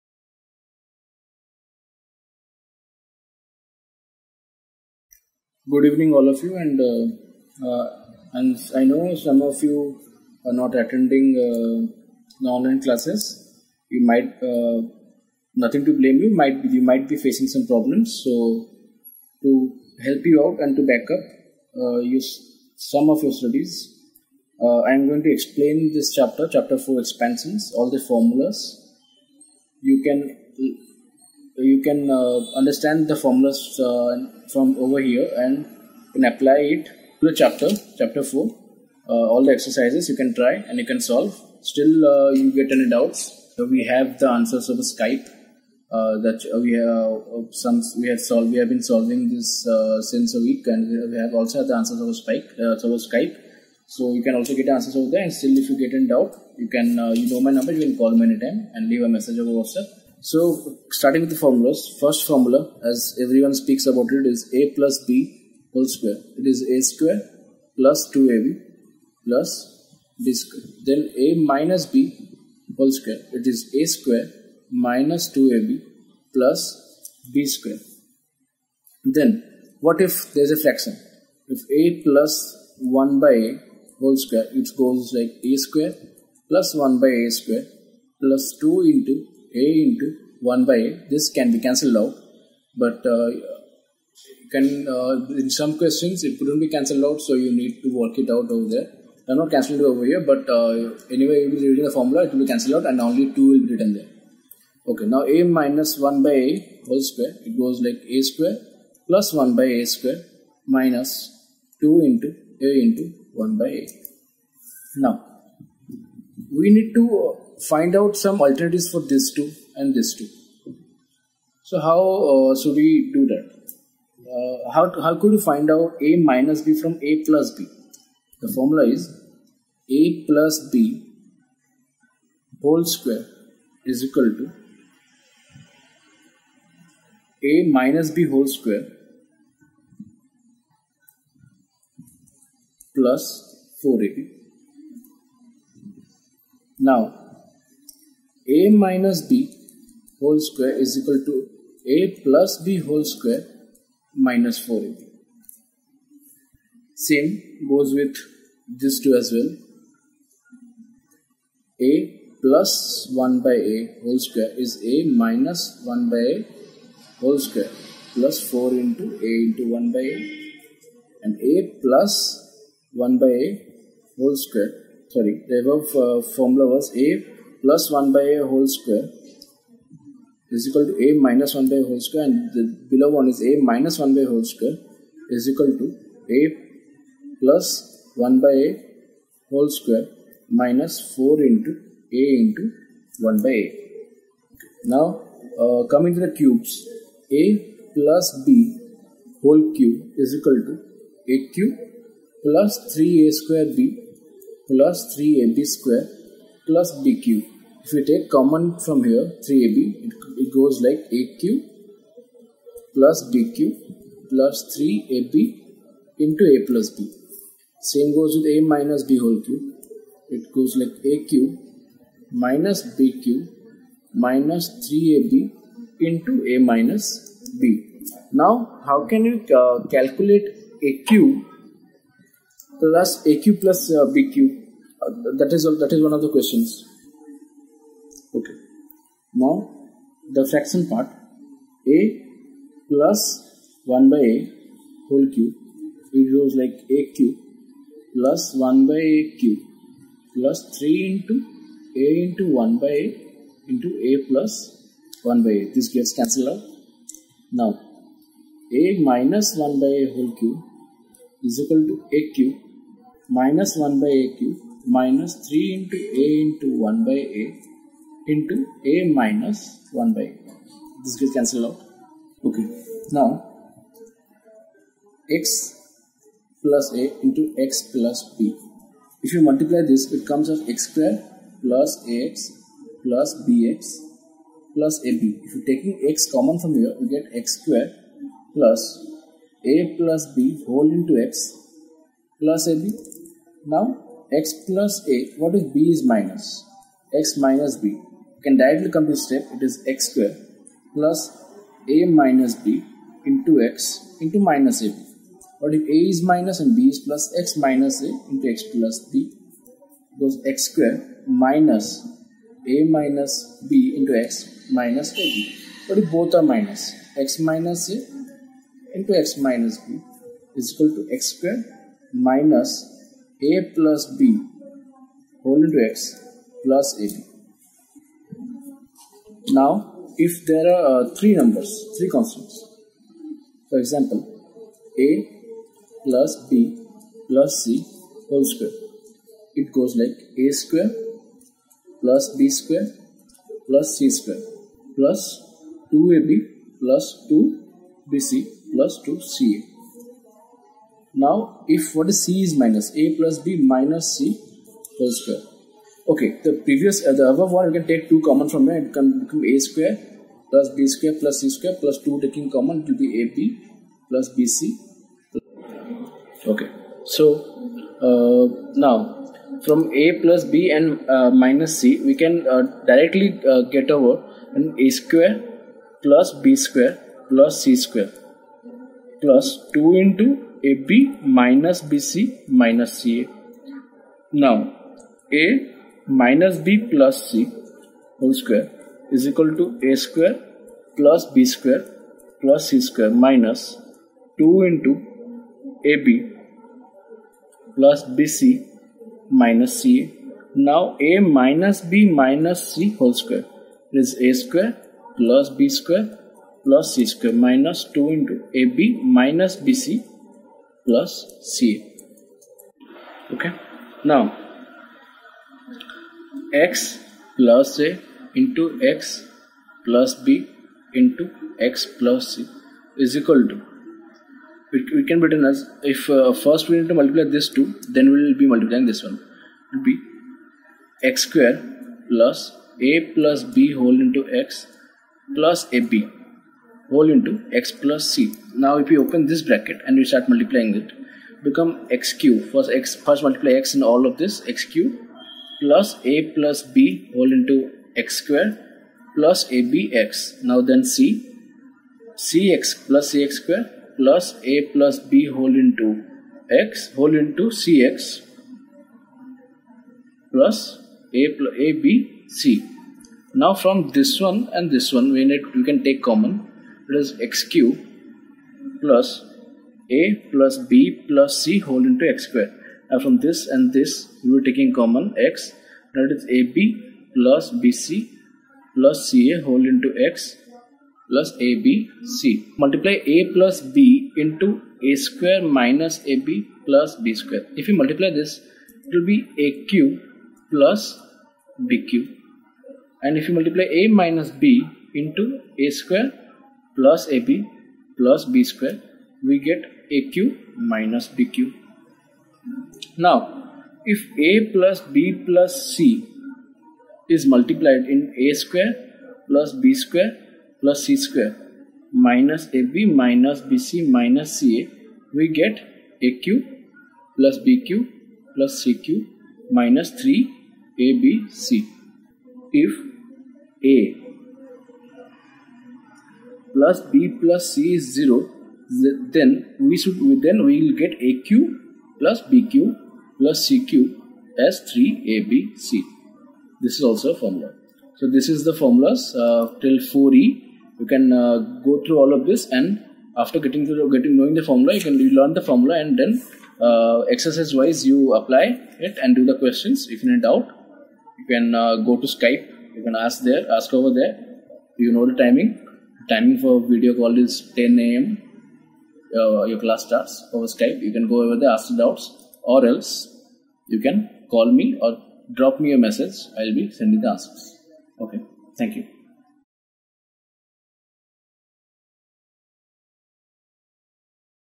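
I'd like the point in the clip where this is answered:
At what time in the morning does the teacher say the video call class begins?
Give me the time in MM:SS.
09:17.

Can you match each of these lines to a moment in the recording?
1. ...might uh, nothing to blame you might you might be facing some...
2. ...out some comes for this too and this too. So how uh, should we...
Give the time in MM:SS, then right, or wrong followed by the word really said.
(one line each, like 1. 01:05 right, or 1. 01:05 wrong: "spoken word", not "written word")
1. 00:14 right
2. 01:57 wrong: "alternatives", not "comes".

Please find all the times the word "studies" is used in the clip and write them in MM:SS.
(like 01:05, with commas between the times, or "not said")
00:23.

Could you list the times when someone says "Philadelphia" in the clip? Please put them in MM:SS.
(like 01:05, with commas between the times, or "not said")
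not said.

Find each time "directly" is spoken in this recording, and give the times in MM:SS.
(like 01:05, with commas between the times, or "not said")
04:58, 06:12.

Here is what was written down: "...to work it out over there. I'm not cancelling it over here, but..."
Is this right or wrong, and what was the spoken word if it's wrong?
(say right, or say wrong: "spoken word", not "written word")
right.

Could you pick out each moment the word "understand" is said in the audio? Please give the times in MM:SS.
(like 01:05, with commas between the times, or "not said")
00:32.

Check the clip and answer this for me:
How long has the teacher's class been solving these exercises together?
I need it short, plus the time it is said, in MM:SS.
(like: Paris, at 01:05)
a week, at 00:50.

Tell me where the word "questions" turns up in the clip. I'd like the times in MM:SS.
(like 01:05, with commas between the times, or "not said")
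01:35, 03:56, 09:09.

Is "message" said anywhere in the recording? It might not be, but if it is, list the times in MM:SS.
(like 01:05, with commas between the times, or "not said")
00:59, 09:25.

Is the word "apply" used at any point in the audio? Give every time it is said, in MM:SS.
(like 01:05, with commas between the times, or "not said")
00:36, 09:08.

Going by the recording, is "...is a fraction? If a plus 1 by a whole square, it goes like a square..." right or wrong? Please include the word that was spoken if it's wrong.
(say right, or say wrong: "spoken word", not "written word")
right.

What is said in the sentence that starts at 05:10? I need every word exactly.
Goes x square minus a minus b into x minus ab.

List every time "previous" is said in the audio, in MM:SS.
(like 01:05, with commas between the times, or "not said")
05:56.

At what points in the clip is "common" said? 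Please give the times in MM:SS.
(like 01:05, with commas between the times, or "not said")
03:28, 04:46, 05:58, 06:02, 07:46, 07:54.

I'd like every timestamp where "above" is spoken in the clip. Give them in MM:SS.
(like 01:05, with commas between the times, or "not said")
02:55, 05:57.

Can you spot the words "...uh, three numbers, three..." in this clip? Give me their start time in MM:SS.
05:31.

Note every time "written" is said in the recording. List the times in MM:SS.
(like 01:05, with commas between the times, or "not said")
01:43, 07:05.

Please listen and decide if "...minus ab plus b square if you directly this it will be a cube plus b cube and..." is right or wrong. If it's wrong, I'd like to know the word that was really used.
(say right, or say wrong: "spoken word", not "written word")
wrong: "multiply", not "directly".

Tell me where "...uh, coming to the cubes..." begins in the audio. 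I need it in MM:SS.
03:15.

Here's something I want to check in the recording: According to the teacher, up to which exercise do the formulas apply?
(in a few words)
4e.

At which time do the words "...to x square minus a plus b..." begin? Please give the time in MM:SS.
05:20.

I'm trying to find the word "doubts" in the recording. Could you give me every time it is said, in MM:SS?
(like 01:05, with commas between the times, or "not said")
00:42, 00:56, 09:10, 09:21.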